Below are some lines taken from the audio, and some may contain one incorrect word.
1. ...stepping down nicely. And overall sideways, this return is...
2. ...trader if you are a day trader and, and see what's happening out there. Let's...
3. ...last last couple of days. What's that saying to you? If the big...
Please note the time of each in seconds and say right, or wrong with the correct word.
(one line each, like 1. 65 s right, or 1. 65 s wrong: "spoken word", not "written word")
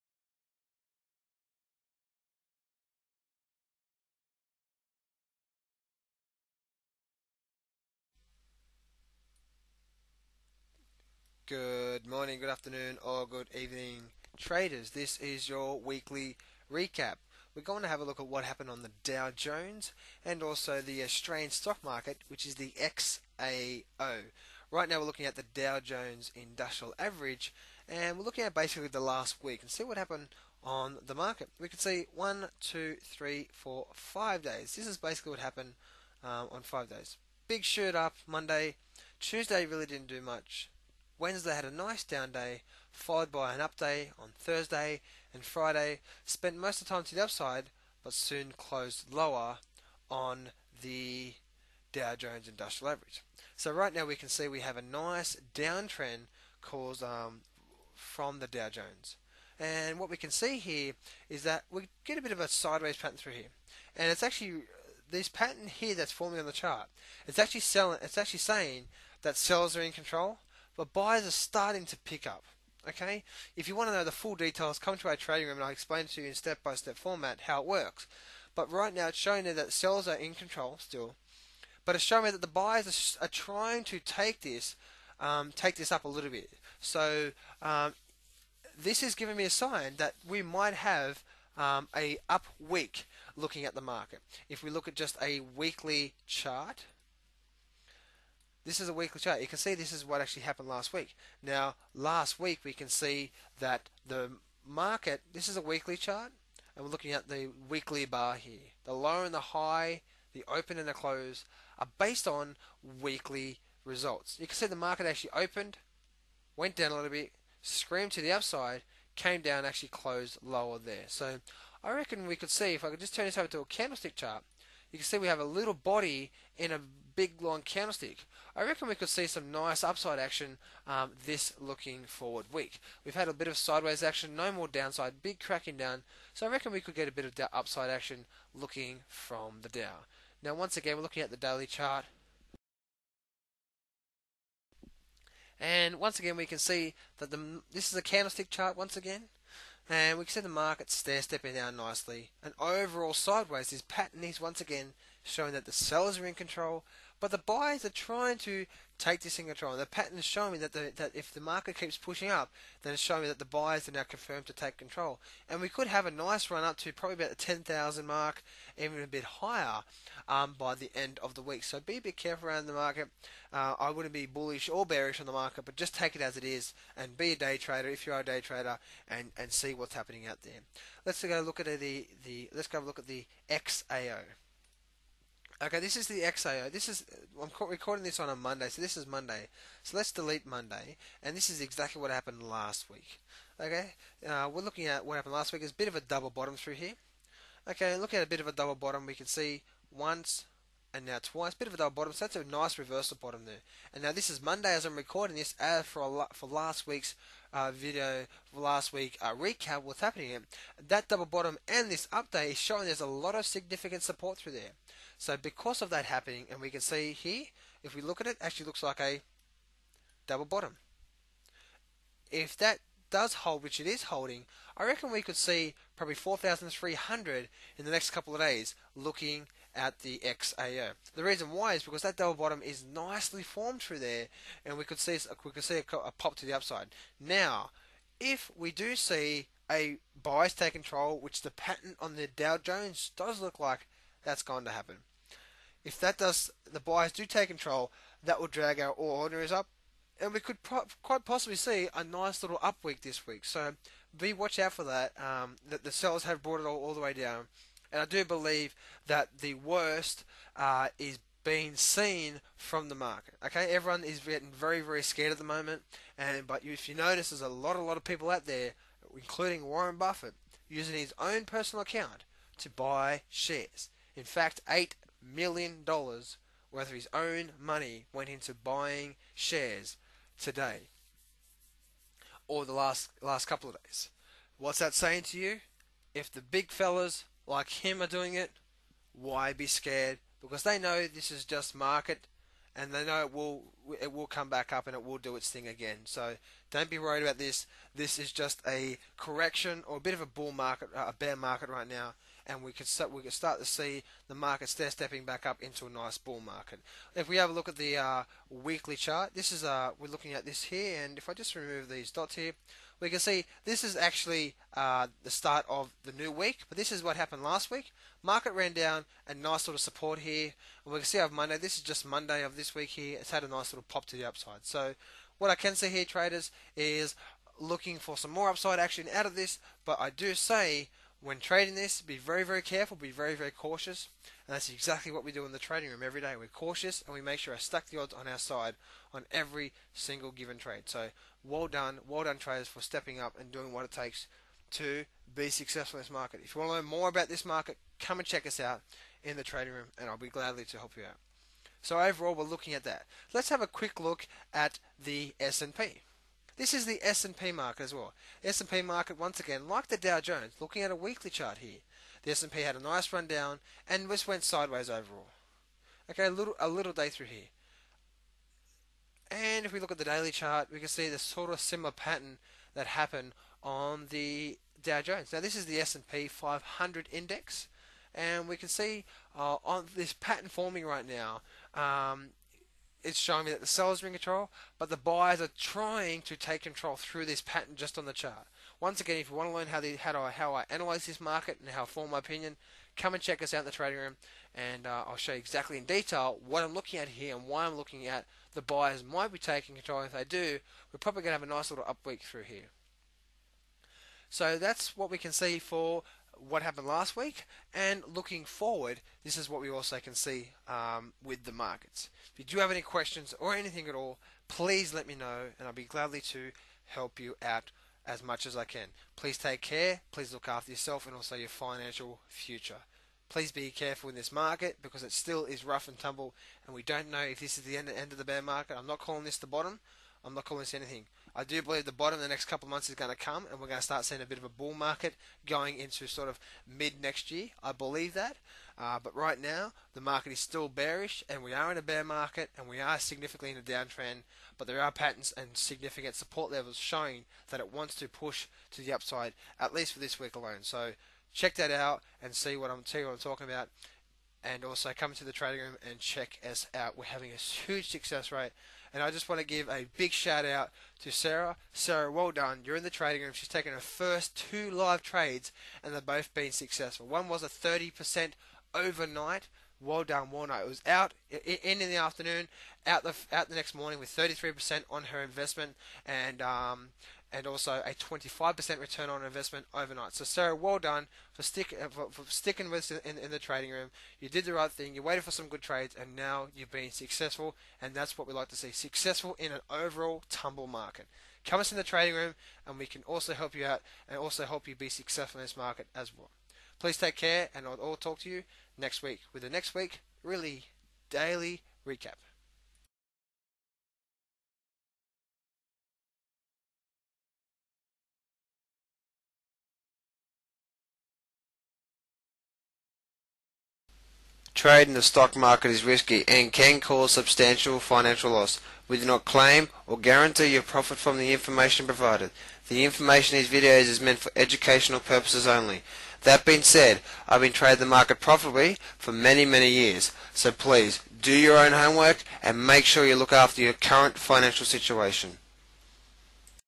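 1. 151 s wrong: "pattern", not "return"
2. 177 s right
3. 282 s right.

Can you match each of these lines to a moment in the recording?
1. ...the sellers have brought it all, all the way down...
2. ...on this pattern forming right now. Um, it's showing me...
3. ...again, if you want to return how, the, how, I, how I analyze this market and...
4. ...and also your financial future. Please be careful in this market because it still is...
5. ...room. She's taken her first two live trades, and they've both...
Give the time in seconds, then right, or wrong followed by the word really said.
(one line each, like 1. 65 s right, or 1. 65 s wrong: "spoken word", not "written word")
1. 255 s right
2. 379 s right
3. 389 s wrong: "learn", not "return"
4. 421 s right
5. 463 s right.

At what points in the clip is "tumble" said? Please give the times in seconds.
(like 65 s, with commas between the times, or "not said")
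425 s, 490 s.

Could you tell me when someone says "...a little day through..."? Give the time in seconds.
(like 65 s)
366 s.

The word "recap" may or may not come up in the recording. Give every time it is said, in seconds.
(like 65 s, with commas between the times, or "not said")
16 s, 209 s, 501 s.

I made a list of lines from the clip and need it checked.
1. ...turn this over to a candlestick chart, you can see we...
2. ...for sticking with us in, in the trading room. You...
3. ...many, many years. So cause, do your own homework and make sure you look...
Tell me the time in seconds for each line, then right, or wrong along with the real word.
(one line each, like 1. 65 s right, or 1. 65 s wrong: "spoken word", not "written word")
1. 123 s right
2. 482 s right
3. 529 s wrong: "please", not "cause".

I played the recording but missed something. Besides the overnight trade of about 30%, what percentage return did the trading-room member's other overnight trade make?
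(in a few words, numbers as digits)
25%.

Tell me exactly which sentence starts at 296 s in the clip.
So don't be worried about this.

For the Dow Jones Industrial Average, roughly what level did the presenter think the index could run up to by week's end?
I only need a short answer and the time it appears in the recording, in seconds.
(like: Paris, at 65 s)
10,000, at 167 s.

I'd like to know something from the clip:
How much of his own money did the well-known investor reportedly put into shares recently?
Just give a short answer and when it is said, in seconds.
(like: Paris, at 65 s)
$8 million, at 274 s.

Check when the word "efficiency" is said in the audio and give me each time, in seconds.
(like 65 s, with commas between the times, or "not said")
not said.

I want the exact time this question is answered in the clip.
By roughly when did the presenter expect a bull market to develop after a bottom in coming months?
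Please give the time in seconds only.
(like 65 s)
436 s.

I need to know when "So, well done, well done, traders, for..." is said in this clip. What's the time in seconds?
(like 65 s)
340 s.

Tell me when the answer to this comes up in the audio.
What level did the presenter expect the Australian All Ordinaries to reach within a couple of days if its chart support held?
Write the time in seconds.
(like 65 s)
226 s.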